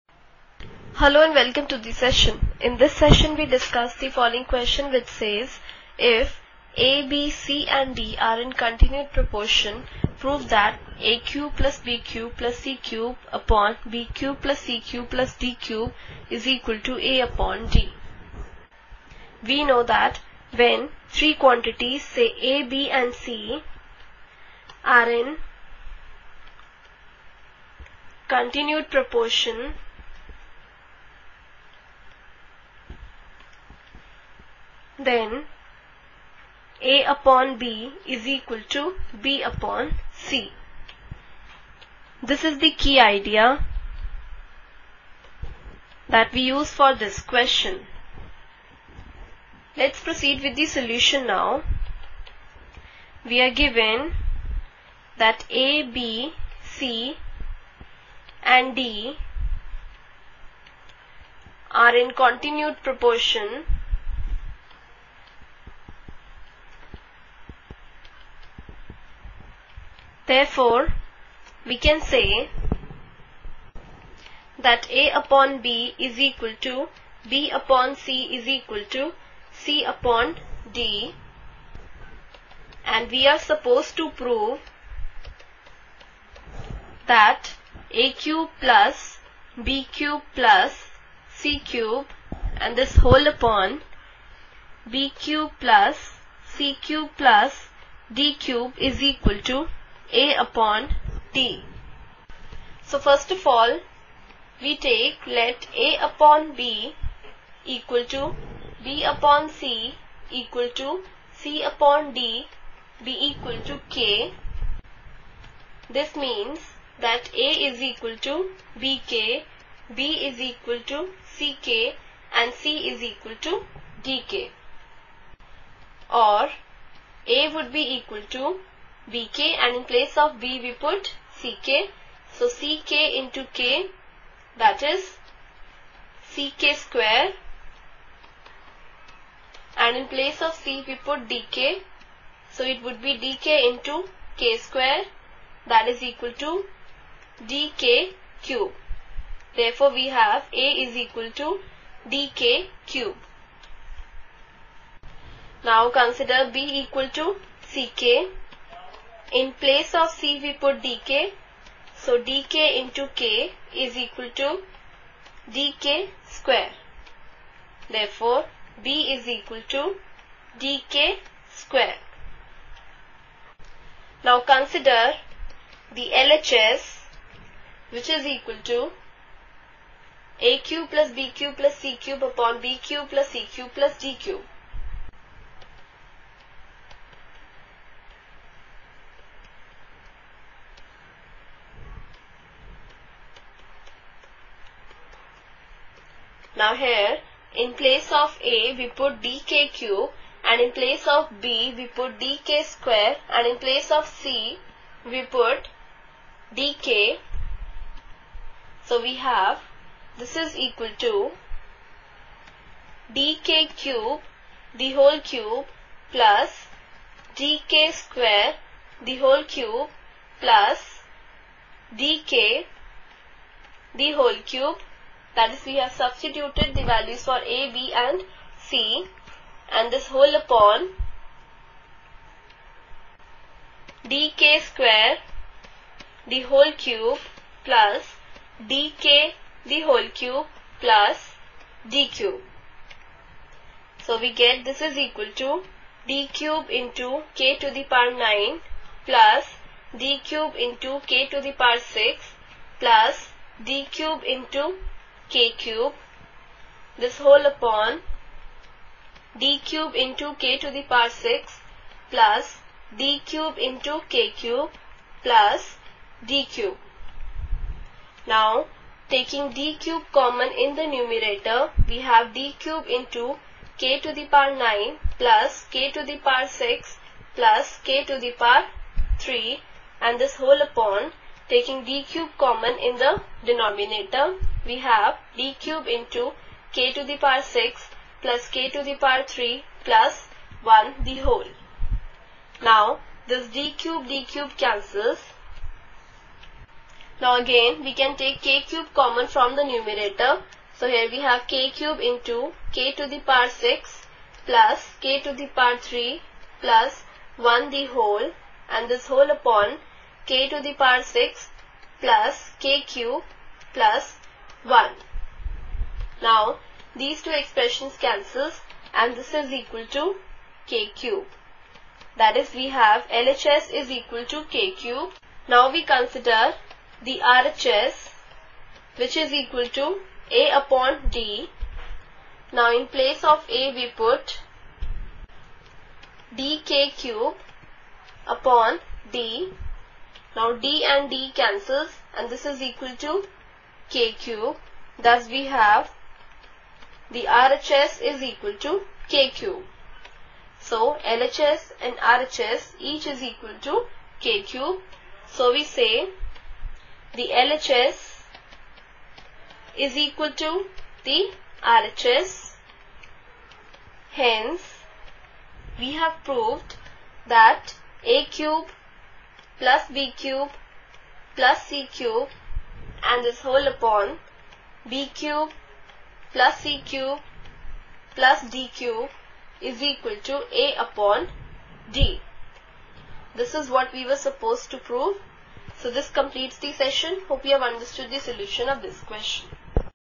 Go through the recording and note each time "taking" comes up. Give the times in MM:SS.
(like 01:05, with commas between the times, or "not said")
04:29, 04:41.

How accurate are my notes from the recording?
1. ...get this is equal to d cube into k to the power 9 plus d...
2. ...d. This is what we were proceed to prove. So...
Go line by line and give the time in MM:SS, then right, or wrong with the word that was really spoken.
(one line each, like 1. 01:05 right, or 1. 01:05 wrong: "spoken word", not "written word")
1. 04:04 right
2. 06:21 wrong: "supposed", not "proceed".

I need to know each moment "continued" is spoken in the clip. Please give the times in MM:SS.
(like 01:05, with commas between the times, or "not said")
00:08, 00:28, 01:02.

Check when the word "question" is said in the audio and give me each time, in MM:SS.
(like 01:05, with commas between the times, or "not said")
00:04, 00:47, 06:29.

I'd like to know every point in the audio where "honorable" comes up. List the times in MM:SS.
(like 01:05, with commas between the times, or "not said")
not said.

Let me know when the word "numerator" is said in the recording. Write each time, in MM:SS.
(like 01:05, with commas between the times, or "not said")
04:30, 04:59.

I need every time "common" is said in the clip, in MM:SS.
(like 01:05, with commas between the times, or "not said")
04:30, 04:42, 04:58.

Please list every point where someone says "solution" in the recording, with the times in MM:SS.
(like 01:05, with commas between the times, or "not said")
00:50, 06:28.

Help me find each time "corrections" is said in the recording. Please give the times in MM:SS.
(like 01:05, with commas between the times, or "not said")
not said.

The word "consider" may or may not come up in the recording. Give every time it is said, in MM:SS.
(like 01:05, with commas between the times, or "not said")
02:36, 02:54, 05:25.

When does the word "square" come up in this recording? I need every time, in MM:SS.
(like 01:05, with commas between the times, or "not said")
02:16, 02:24, 02:46, 02:51, 03:22, 03:38, 03:54.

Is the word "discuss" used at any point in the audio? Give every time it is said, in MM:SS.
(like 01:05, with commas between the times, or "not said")
00:03.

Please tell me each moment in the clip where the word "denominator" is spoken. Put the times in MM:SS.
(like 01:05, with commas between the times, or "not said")
04:43.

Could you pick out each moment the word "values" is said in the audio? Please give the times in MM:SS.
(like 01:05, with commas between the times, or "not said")
03:46.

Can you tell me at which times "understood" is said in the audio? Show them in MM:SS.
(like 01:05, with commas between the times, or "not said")
06:27.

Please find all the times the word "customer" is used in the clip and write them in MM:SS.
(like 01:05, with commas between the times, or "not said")
not said.